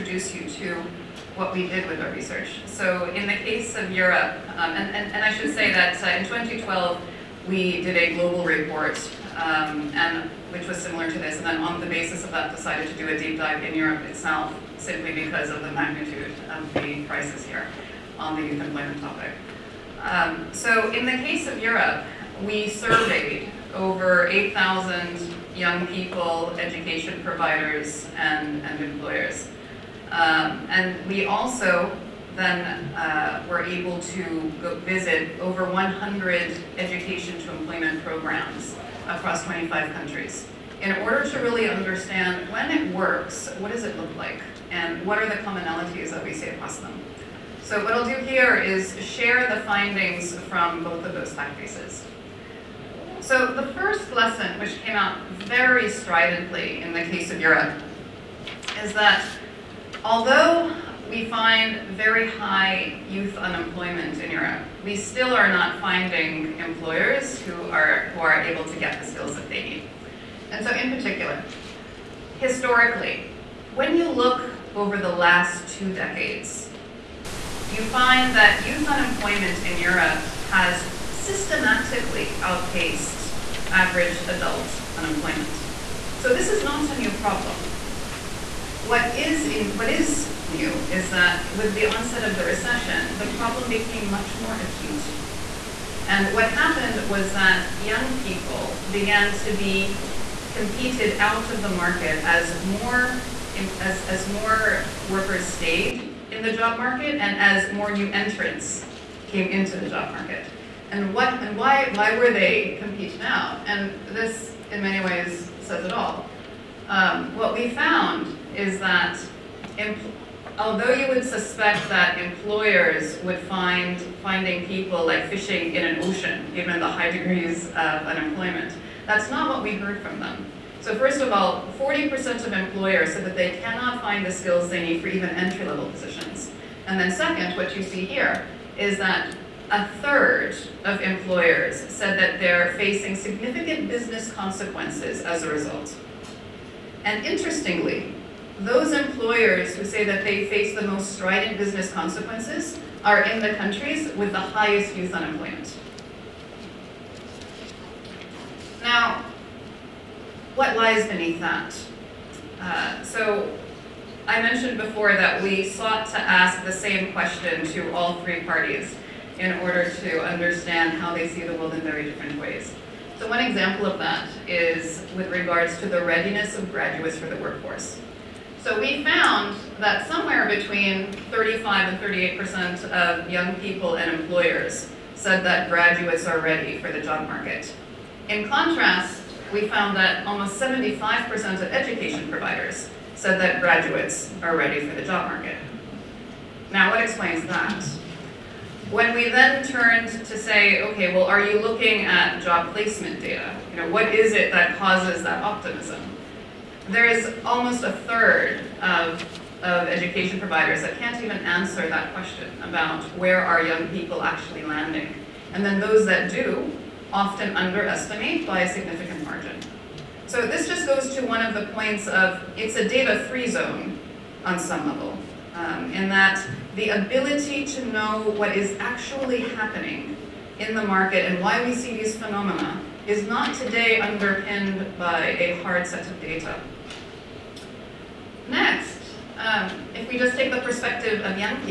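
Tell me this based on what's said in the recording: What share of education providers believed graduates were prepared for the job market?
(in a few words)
almost 75%.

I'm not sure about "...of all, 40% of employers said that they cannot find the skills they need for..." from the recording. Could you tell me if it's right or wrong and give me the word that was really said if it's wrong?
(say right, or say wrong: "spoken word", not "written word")
right.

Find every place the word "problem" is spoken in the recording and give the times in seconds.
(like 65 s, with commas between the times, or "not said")
87 s, 93 s.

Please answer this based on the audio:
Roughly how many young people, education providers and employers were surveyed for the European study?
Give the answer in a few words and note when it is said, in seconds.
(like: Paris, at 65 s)
8,000, at 24 s.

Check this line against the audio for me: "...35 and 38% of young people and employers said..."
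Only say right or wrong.
right.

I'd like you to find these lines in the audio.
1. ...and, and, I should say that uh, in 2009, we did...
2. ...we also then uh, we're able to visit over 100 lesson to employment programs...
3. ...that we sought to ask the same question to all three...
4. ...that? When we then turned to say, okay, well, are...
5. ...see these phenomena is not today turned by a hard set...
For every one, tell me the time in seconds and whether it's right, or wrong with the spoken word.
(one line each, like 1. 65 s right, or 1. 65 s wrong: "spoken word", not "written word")
1. 4 s wrong: "2012", not "2009"
2. 31 s wrong: "education", not "lesson"
3. 165 s right
4. 197 s right
5. 231 s wrong: "underpinned", not "turned".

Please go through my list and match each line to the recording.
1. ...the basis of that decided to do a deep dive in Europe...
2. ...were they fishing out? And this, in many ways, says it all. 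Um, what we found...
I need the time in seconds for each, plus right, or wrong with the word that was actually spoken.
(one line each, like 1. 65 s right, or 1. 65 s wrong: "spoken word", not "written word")
1. 11 s right
2. 112 s wrong: "competing", not "fishing".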